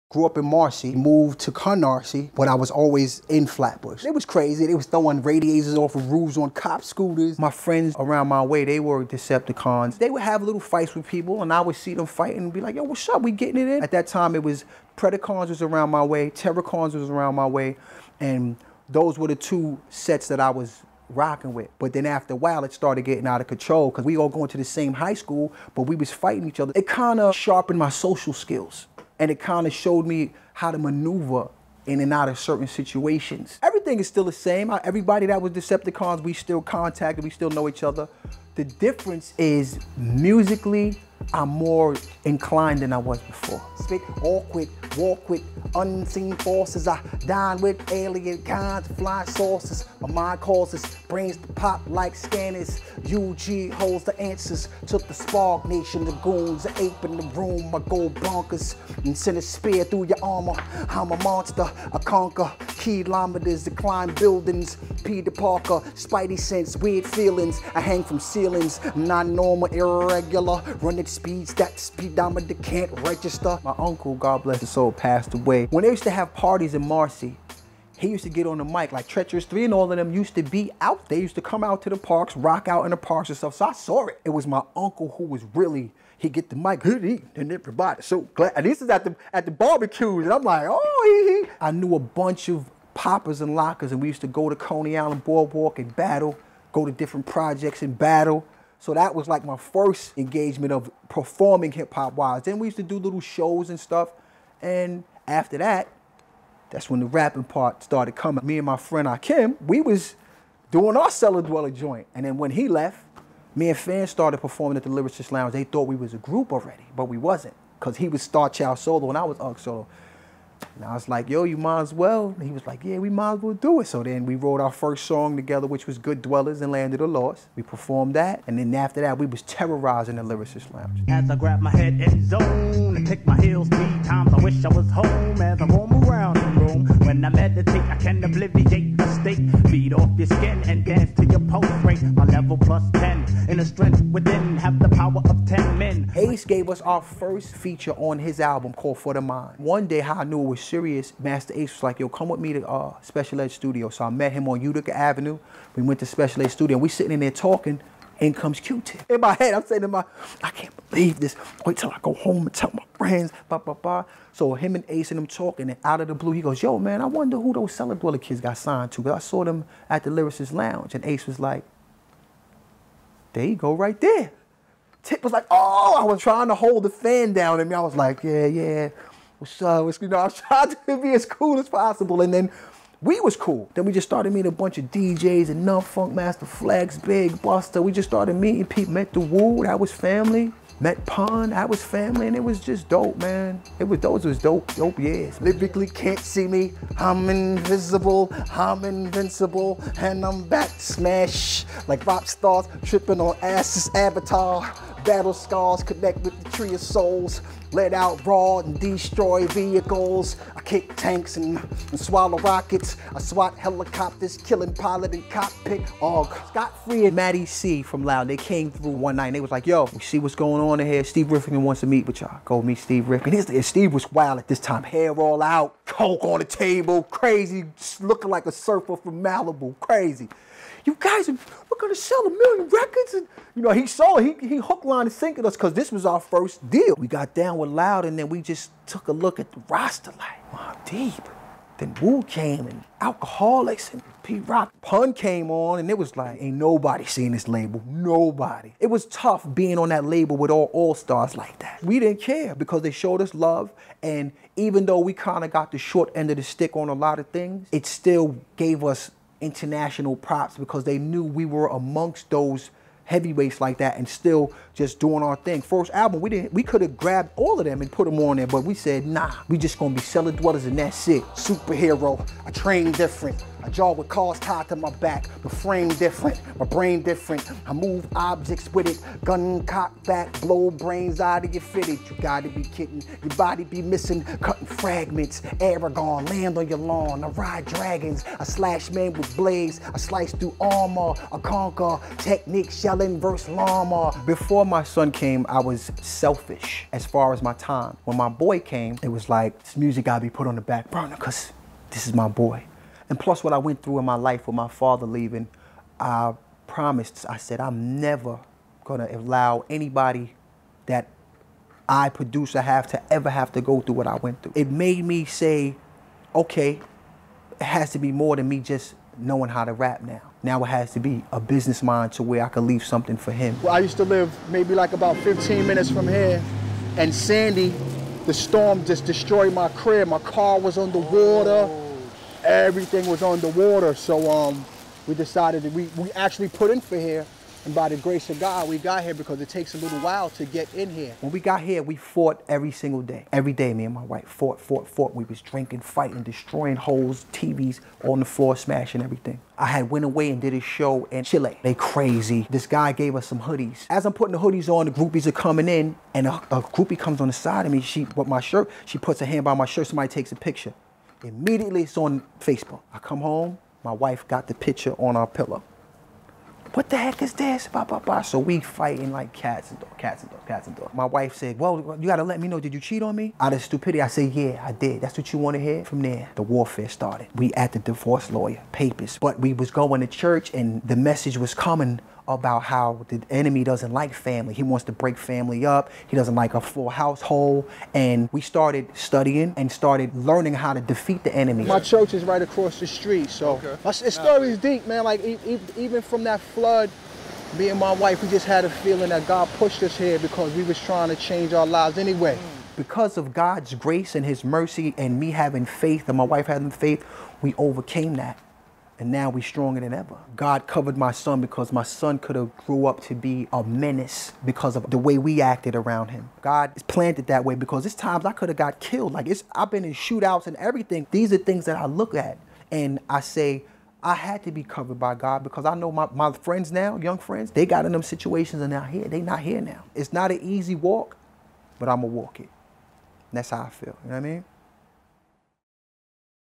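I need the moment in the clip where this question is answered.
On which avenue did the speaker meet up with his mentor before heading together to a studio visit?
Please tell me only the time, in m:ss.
2:34.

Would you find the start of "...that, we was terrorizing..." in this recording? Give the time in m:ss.
2:09.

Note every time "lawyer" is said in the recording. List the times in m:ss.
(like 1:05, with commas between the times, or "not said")
6:18.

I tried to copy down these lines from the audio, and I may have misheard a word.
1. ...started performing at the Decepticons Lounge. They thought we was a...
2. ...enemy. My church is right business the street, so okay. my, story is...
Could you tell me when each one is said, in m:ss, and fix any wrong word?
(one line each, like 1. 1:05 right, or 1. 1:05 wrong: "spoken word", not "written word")
1. 1:54 wrong: "Lyricist", not "Decepticons"
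2. 6:31 wrong: "across", not "business".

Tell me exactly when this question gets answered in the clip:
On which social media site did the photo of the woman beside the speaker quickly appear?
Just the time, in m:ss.
6:02.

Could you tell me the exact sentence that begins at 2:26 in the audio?
Ace gave us our first feature on his album called For the Mind.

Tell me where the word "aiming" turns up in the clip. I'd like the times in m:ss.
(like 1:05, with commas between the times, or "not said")
not said.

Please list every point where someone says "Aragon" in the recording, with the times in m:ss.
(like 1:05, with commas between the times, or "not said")
4:45.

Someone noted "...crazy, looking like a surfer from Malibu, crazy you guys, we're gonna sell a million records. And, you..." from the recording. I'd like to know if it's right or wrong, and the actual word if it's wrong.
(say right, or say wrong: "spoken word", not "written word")
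right.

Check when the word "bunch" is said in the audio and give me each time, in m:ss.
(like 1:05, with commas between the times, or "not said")
1:31, 3:04.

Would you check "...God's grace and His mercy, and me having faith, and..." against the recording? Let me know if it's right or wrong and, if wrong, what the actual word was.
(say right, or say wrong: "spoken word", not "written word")
right.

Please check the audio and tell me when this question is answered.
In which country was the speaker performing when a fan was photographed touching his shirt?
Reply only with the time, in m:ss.
5:51.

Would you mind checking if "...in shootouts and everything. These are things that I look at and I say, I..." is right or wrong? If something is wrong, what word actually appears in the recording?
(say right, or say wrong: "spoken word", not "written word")
right.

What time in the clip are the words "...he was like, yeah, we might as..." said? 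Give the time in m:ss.
2:02.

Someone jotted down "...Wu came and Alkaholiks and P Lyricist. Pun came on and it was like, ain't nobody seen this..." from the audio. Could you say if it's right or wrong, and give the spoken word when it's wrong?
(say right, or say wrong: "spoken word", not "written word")
wrong: "Rock", not "Lyricist".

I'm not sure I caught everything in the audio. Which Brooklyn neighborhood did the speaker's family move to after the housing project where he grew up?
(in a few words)
Canarsie.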